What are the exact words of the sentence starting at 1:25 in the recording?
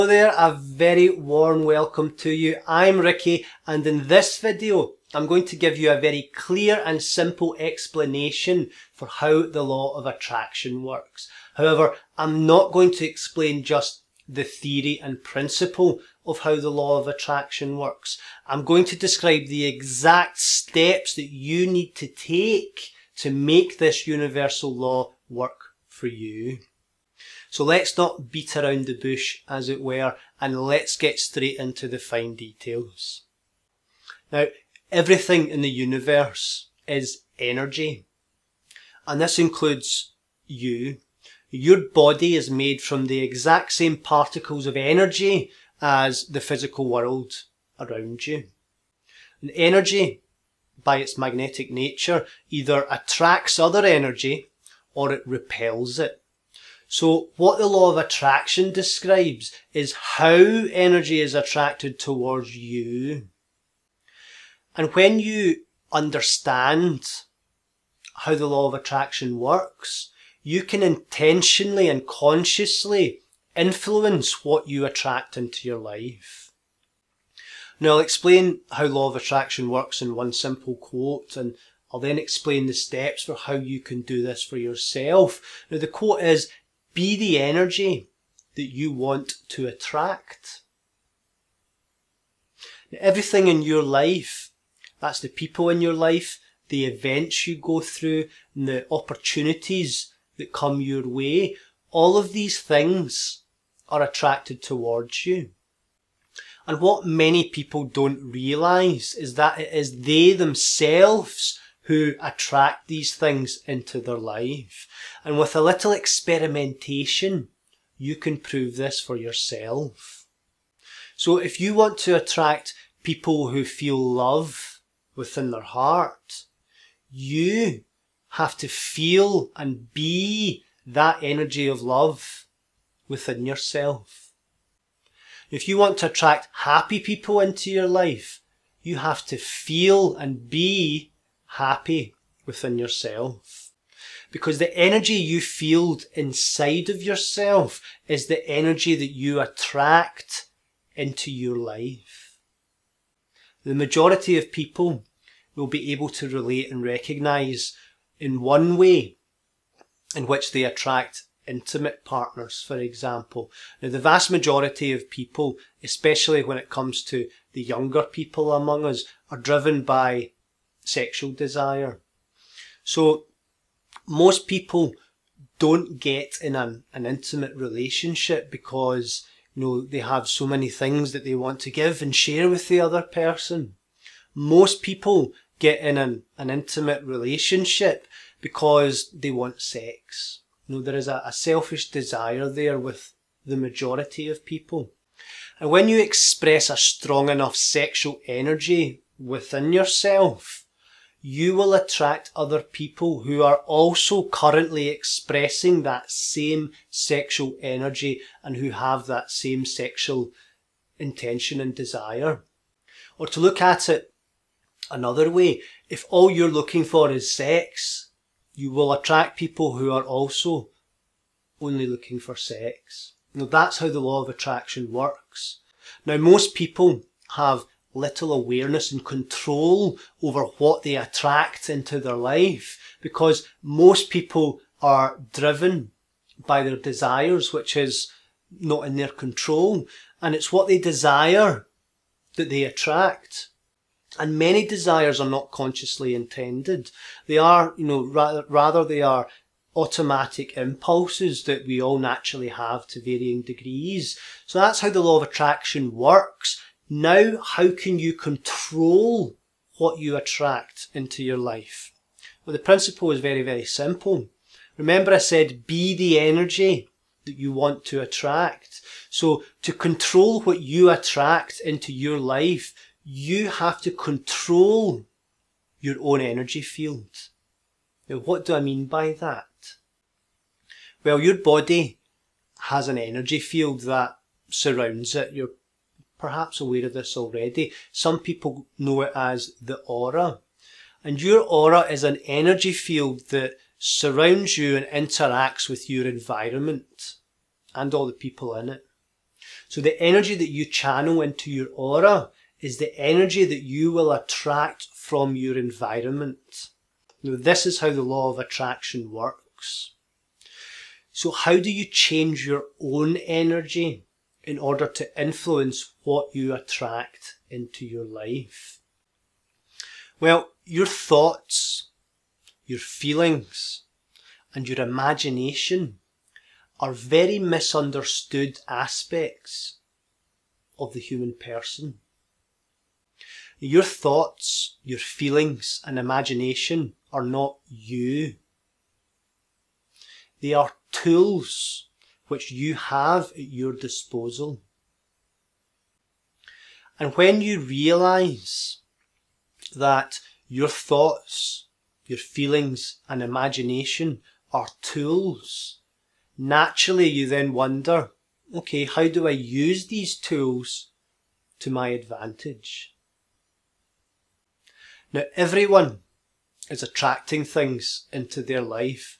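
Now the quote is, be the energy that you want to attract.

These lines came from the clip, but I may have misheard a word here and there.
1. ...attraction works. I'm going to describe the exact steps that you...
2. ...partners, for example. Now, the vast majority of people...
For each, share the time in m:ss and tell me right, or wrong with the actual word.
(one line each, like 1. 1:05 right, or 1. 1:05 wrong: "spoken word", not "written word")
1. 0:17 right
2. 2:42 right.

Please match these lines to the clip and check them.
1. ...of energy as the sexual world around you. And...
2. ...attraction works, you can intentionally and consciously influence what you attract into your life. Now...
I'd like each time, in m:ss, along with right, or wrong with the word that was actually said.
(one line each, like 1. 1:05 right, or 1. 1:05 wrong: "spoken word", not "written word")
1. 0:44 wrong: "physical", not "sexual"
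2. 1:08 right.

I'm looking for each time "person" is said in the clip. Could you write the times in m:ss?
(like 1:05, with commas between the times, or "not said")
3:03, 5:31.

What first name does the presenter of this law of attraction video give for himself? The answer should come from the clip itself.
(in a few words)
Ricky.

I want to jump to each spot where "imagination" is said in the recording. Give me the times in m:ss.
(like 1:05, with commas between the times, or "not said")
5:24, 5:35, 5:53.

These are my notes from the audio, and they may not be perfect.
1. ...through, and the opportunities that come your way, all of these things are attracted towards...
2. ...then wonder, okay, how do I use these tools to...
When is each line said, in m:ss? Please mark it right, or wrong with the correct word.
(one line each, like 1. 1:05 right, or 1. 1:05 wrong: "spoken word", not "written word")
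1. 1:37 right
2. 5:57 right.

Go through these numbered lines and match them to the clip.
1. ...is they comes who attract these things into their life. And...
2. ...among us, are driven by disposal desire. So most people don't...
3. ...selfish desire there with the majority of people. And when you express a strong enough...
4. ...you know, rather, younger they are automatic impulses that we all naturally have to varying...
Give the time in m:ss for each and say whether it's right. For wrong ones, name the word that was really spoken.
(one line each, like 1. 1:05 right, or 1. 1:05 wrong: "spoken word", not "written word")
1. 1:49 wrong: "themselves", not "comes"
2. 2:48 wrong: "sexual", not "disposal"
3. 3:11 right
4. 4:07 wrong: "rather", not "younger".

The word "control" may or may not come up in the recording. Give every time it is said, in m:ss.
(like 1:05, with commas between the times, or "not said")
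3:49, 3:59, 4:18, 4:29, 4:33.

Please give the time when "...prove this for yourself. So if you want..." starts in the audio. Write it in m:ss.
1:58.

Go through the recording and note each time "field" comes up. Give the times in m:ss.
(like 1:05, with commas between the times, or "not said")
4:36, 4:43, 4:52.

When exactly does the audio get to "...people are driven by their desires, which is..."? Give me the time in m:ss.
3:54.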